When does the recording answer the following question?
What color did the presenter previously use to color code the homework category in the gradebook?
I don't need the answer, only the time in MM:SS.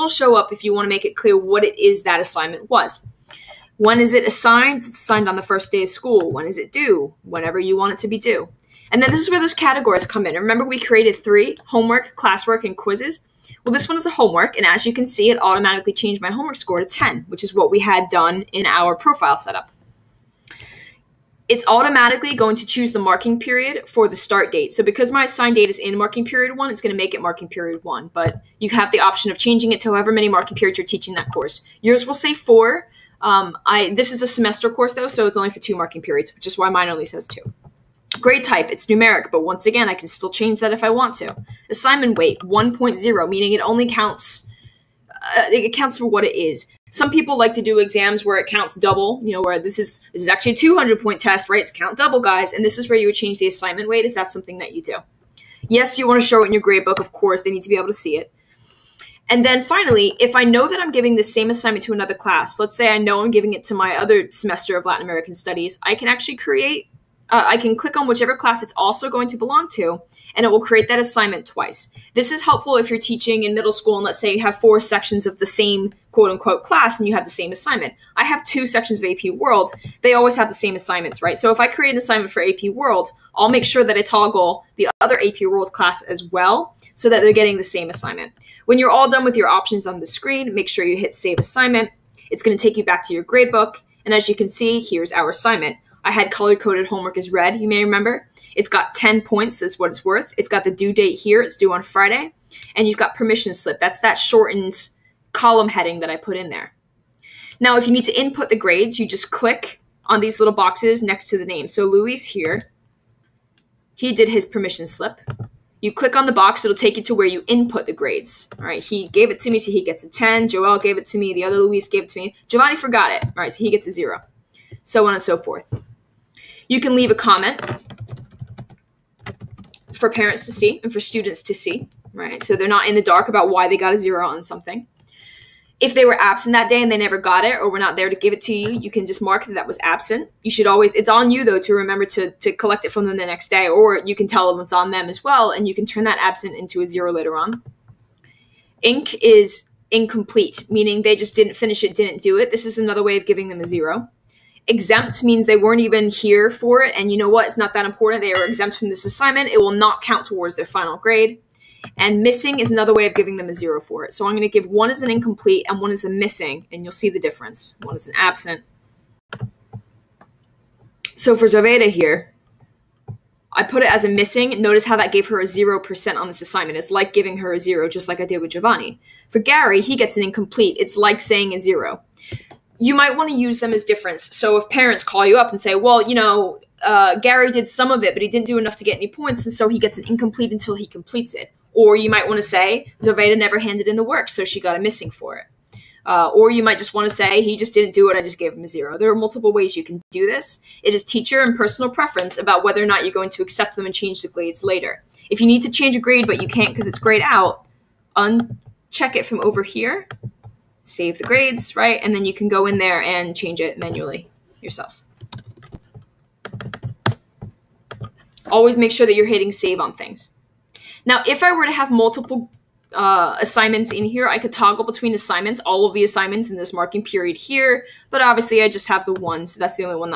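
01:37.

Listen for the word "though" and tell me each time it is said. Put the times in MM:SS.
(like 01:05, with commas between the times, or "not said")
00:34, 02:21.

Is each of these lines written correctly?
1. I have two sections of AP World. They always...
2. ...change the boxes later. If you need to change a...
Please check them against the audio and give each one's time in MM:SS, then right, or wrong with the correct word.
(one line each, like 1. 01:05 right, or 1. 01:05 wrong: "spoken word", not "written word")
1. 01:18 right
2. 03:23 wrong: "grades", not "boxes".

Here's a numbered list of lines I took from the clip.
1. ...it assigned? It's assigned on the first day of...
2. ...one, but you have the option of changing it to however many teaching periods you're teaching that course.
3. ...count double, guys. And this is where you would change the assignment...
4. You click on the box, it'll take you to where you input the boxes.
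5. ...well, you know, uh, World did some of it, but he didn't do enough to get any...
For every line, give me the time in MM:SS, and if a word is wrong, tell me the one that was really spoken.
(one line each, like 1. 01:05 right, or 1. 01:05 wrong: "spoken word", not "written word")
1. 00:04 right
2. 00:27 wrong: "marking", not "teaching"
3. 00:51 right
4. 01:55 wrong: "grades", not "boxes"
5. 03:05 wrong: "Gary", not "World".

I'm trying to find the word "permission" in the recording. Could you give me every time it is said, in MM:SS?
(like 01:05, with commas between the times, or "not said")
01:43, 01:54.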